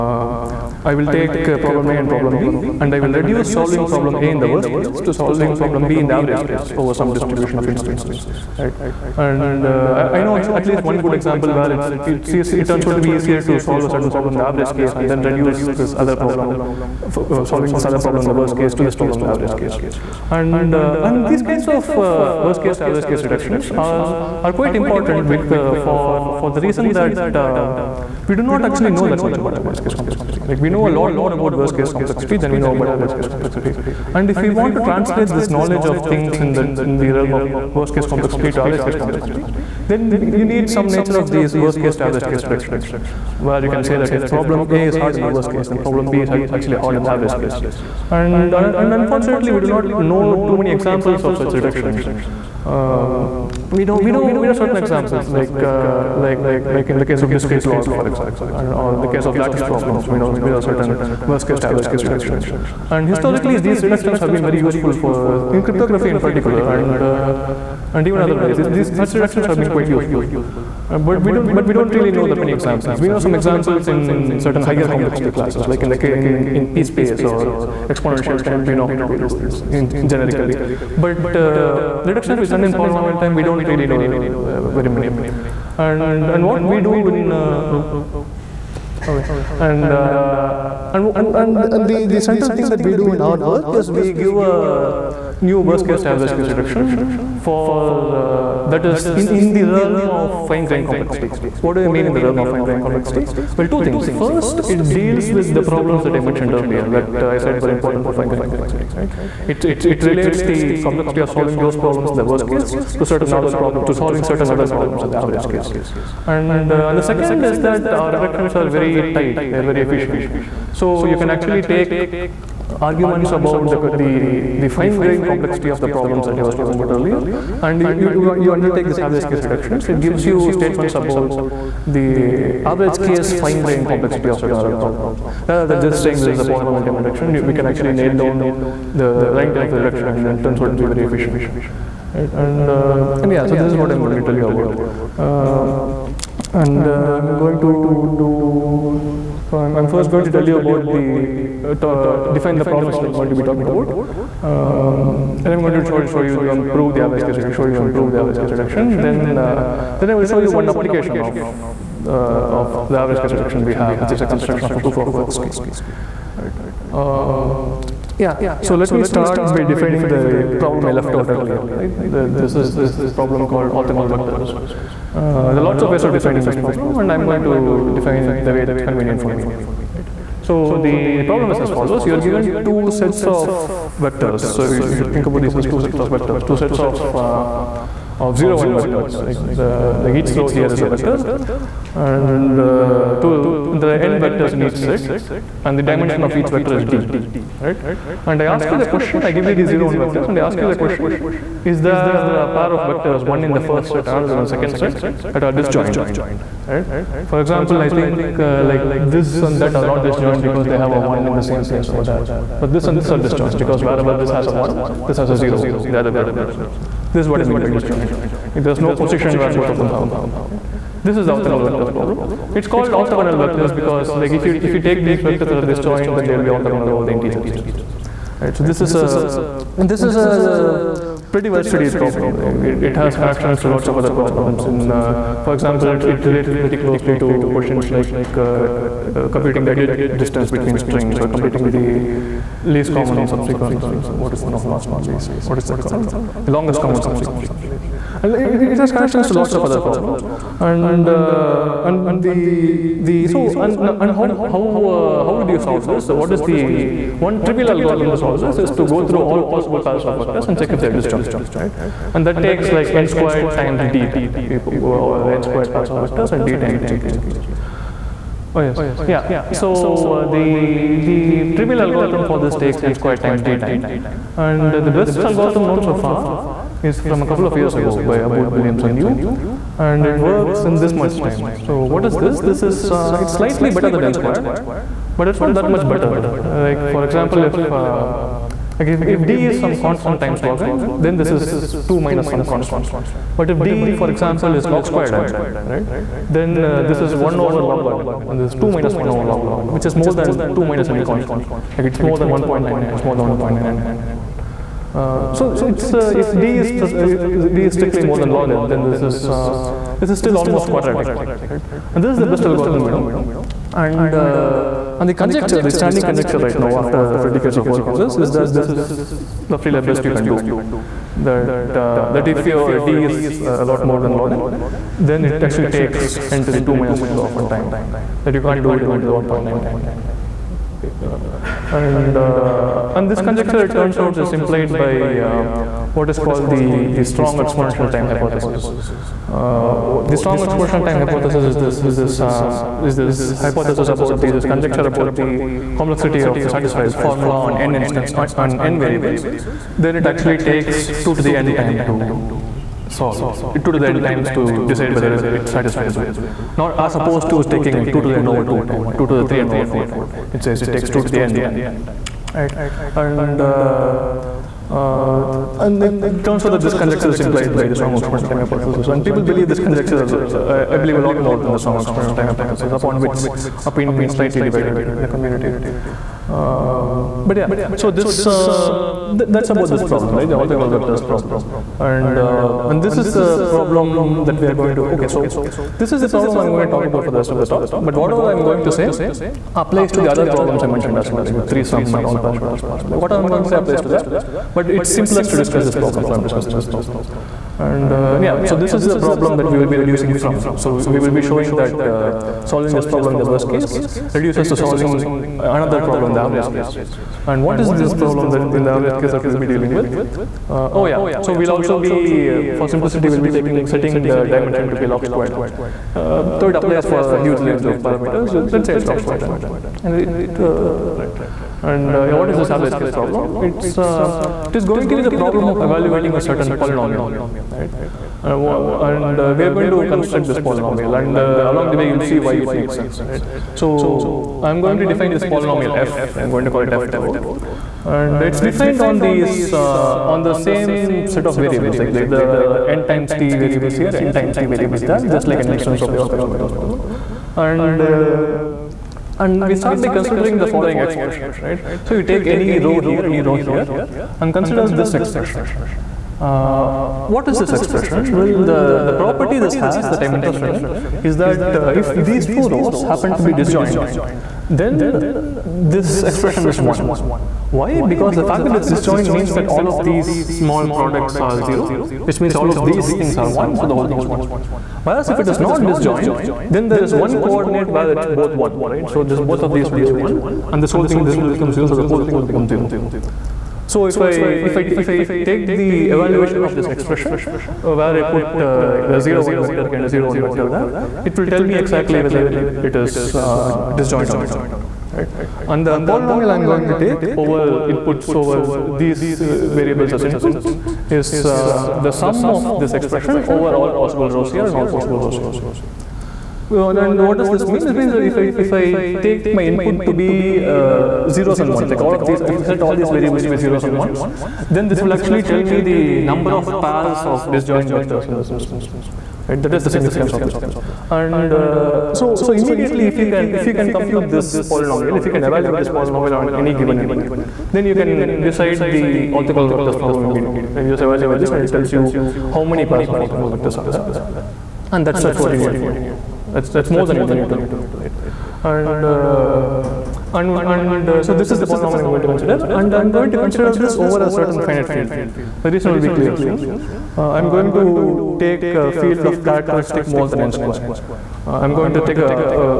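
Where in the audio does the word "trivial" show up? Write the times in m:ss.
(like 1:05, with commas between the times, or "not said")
4:17, 4:31.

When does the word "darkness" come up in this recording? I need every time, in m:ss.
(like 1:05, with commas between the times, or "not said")
not said.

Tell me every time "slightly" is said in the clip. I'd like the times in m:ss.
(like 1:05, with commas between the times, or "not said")
4:43, 6:14.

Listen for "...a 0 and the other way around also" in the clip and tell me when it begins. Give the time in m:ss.
3:35.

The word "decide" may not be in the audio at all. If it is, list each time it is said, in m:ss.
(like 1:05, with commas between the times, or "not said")
5:54, 8:48.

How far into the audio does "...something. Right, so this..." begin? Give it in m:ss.
3:47.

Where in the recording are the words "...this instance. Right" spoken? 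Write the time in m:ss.
8:38.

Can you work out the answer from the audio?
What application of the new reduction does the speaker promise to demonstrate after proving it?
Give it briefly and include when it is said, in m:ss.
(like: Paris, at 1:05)
Proof of work scheme, at 2:44.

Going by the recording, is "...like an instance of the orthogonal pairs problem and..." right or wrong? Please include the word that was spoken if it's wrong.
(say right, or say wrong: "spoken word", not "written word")
wrong: "vectors", not "pairs".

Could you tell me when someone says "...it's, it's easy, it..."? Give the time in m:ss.
0:11.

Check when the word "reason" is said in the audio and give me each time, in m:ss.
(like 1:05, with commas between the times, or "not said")
0:26, 9:05.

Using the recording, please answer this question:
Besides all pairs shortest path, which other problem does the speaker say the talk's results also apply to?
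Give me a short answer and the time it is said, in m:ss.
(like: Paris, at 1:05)
Three-sum, at 6:31.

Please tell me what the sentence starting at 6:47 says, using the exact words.
And what is this problem that in the average case that we'll be dealing with?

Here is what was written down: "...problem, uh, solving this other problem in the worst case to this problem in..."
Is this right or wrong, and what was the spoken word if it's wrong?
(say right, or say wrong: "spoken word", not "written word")
right.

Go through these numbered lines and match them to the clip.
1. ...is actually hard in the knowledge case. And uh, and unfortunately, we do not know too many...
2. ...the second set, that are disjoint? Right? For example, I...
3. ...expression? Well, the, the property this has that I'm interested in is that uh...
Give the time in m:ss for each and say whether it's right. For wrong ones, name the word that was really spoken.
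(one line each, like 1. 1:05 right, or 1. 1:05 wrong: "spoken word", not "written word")
1. 0:46 wrong: "average", not "knowledge"
2. 3:24 right
3. 7:37 right.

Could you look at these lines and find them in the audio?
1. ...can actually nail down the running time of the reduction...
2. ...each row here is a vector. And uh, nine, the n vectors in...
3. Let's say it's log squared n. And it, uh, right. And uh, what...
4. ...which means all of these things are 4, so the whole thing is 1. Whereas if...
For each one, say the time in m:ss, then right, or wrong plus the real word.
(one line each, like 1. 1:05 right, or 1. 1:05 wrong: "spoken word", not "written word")
1. 2:17 right
2. 3:10 wrong: "two", not "nine"
3. 6:58 right
4. 7:52 wrong: "1", not "4".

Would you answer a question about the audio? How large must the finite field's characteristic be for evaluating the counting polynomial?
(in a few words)
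More than n squared.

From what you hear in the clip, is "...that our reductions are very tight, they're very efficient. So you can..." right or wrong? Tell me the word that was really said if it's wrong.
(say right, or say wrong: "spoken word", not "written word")
right.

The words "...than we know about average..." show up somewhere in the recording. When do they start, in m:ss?
0:32.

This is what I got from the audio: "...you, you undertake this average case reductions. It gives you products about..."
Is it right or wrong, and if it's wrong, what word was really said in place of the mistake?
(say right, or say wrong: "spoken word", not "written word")
wrong: "statements", not "products".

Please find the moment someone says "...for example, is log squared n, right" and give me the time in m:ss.
4:54.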